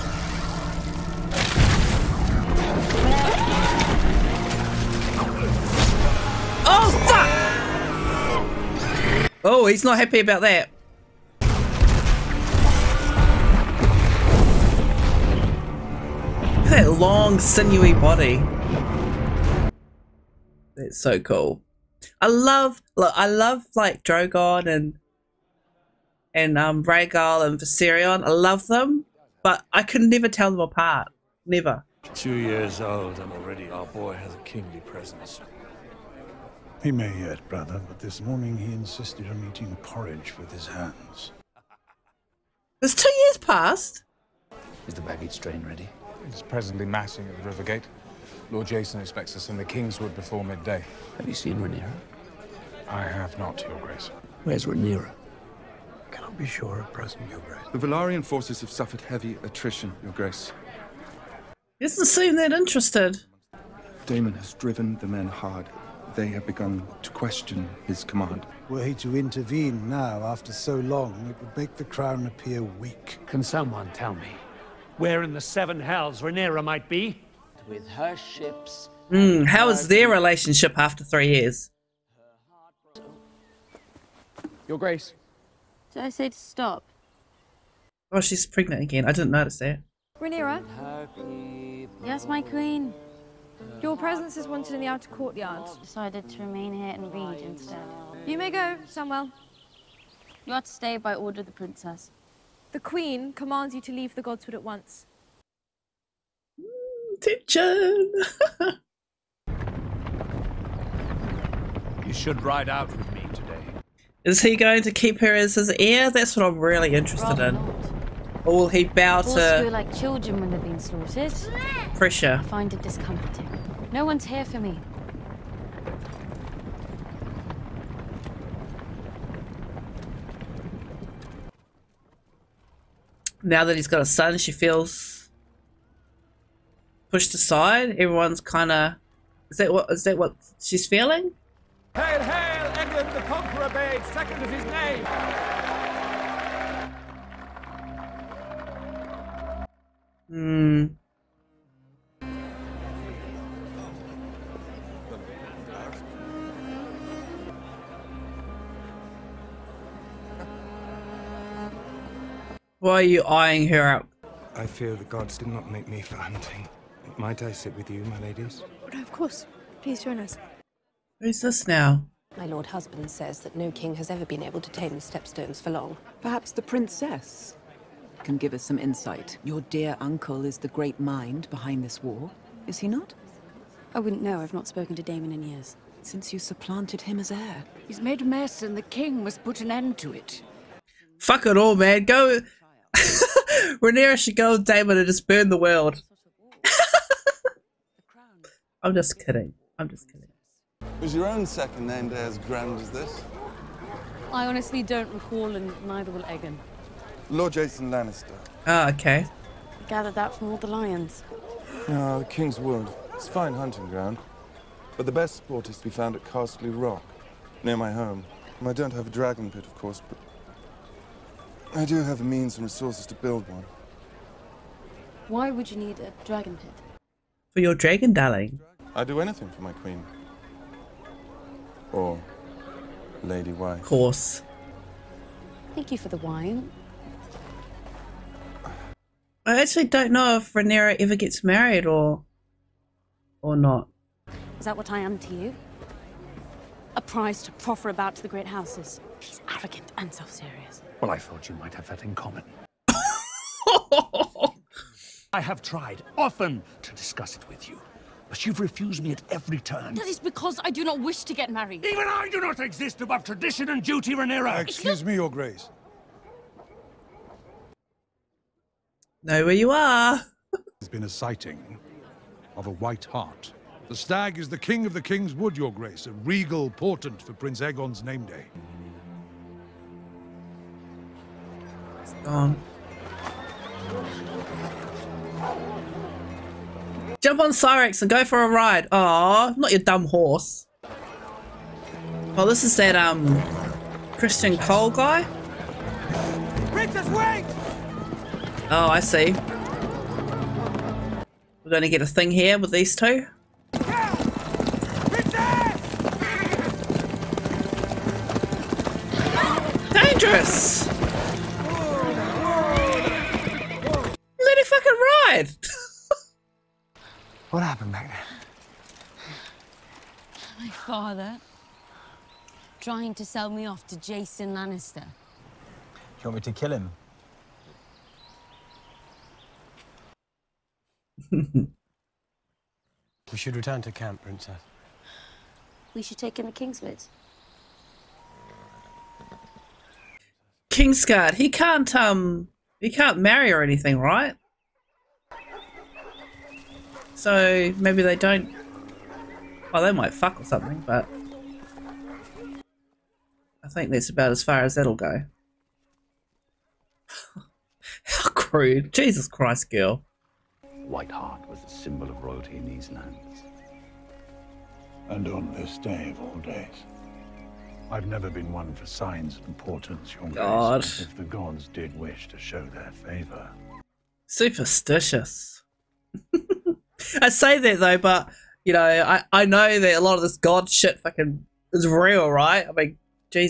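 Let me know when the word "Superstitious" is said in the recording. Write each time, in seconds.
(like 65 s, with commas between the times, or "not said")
374 s.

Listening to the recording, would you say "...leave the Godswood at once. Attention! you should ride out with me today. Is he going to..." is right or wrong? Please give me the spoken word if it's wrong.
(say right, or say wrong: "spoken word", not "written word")
right.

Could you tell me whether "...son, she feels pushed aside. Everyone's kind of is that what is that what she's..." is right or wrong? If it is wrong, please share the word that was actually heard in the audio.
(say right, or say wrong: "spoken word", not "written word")
right.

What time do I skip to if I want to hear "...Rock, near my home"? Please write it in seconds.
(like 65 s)
216 s.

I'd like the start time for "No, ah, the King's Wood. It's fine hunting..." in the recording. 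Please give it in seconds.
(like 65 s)
211 s.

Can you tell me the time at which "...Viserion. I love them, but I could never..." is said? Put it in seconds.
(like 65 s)
27 s.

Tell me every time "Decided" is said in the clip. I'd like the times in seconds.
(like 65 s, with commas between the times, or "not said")
95 s.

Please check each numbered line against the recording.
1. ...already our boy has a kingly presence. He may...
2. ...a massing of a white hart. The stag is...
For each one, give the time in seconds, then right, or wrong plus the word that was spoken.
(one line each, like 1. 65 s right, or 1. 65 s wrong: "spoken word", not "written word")
1. 33 s right
2. 271 s wrong: "sighting", not "massing".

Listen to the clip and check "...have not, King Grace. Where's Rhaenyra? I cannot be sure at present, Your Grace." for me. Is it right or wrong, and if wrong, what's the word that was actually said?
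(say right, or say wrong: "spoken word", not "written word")
wrong: "Your", not "King".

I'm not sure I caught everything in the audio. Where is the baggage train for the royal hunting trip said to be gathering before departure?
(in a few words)
Rivergate.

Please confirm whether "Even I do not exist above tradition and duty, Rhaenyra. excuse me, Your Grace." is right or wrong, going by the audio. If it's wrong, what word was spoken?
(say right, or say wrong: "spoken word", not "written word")
right.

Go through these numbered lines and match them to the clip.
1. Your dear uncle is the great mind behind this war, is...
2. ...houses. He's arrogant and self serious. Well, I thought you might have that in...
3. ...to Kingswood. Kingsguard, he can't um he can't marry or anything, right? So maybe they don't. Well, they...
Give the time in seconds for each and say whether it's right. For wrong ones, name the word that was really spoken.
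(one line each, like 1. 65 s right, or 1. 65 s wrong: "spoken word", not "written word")
1. 179 s right
2. 248 s right
3. 336 s right.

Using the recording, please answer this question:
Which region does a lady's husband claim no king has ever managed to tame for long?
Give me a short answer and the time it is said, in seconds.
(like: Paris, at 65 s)
the stepstones, at 175 s.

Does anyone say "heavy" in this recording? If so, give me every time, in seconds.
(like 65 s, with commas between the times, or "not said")
59 s.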